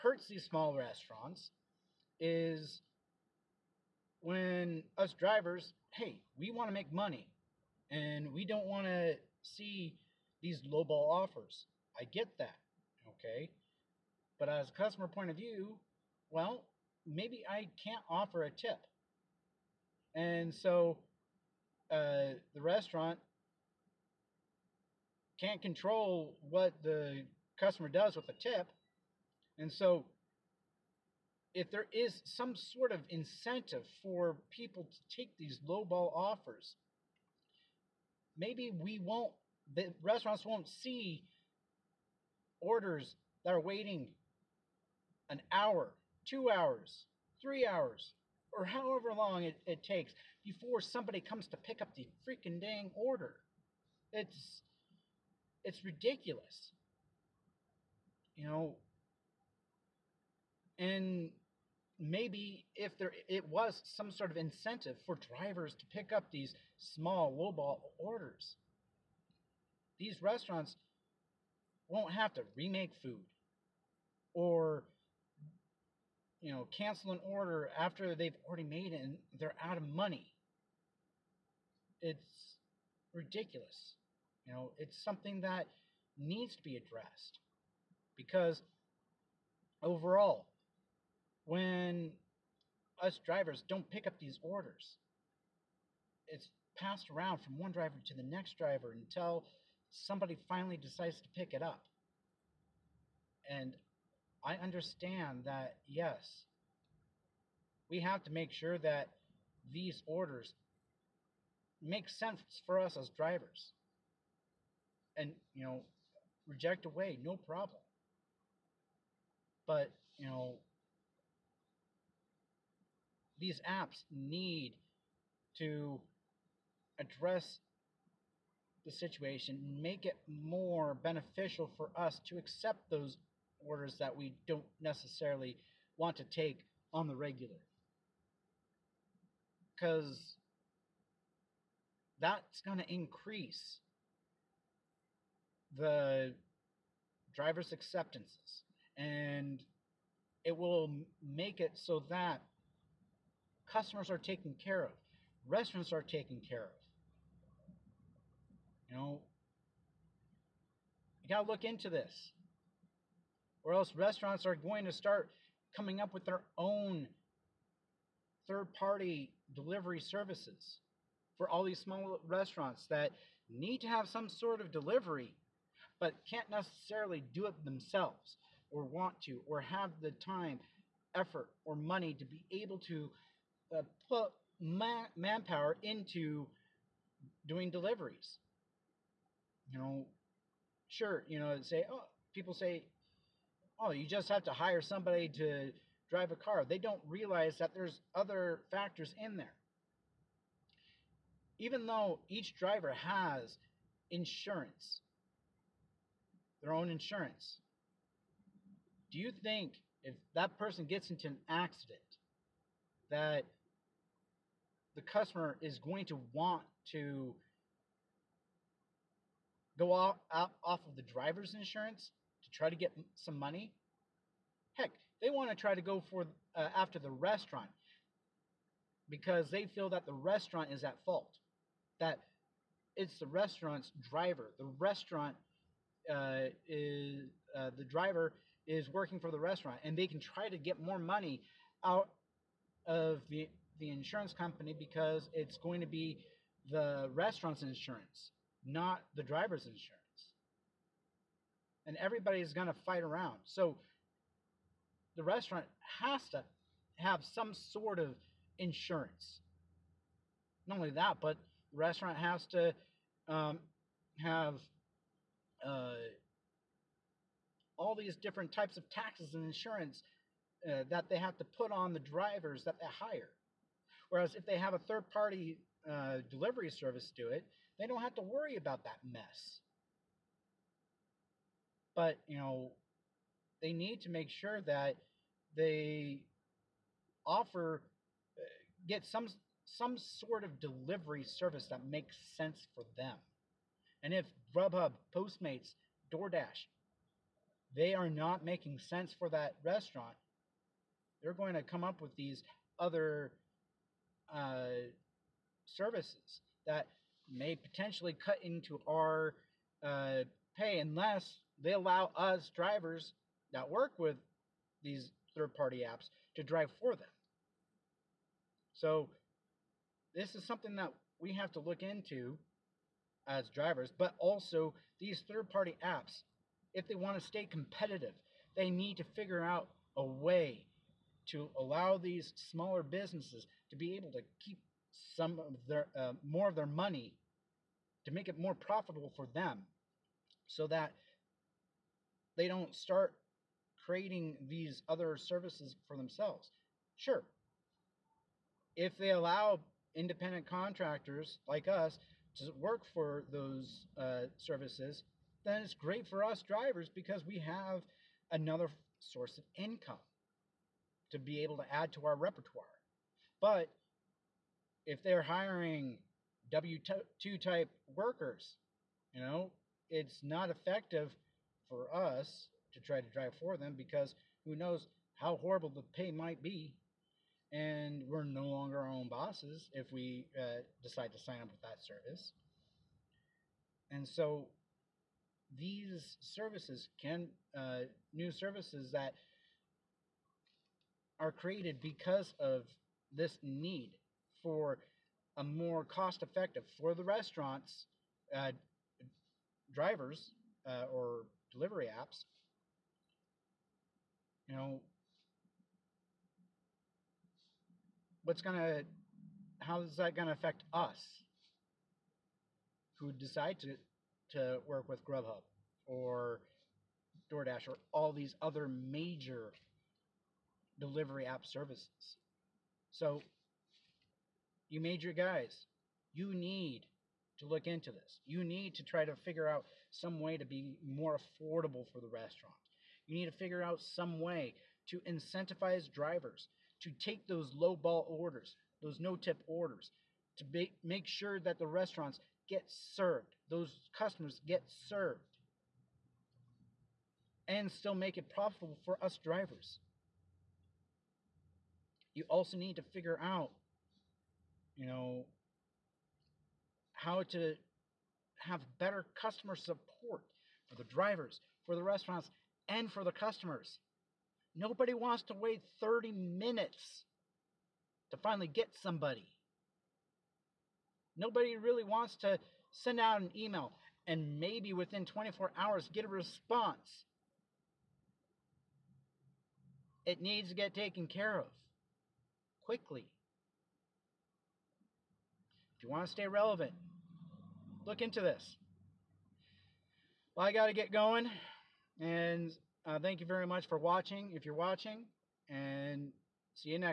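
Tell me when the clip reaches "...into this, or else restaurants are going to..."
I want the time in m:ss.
2:41.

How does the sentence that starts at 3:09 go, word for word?
You know, sure, you know, say, oh, people say, oh, you just have to hire somebody to drive a car.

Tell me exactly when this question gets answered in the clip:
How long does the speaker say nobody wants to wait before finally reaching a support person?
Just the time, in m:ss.
7:45.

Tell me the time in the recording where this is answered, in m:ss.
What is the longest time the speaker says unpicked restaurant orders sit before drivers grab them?
0:47.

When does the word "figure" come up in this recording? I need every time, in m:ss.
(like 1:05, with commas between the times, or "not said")
5:29, 7:09, 7:13, 7:32.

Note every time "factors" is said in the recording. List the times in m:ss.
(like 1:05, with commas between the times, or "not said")
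3:18.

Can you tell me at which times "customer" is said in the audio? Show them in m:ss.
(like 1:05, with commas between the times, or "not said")
0:14, 0:27, 2:33, 3:35, 7:23, 7:39, 7:43.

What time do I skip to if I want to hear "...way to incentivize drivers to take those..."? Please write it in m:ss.
7:14.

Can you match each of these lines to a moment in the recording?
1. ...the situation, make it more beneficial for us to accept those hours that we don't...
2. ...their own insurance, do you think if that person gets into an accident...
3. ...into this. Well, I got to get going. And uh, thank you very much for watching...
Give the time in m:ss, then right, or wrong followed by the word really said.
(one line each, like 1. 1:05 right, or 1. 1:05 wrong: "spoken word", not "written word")
1. 2:08 wrong: "orders", not "hours"
2. 3:26 right
3. 8:08 right.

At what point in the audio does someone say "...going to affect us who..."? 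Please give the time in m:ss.
6:50.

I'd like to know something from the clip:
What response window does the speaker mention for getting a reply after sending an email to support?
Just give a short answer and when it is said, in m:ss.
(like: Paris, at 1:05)
24 hours, at 7:55.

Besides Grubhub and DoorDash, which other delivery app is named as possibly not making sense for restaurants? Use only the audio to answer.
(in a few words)
Postmates.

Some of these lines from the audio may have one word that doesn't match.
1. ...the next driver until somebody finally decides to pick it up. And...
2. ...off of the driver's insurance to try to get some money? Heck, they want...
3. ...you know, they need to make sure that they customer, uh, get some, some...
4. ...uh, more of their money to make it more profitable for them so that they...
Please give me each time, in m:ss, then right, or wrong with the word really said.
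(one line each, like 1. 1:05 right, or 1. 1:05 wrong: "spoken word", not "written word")
1. 1:38 right
2. 3:40 right
3. 4:42 wrong: "offer", not "customer"
4. 5:35 right.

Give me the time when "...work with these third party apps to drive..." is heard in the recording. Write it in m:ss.
5:13.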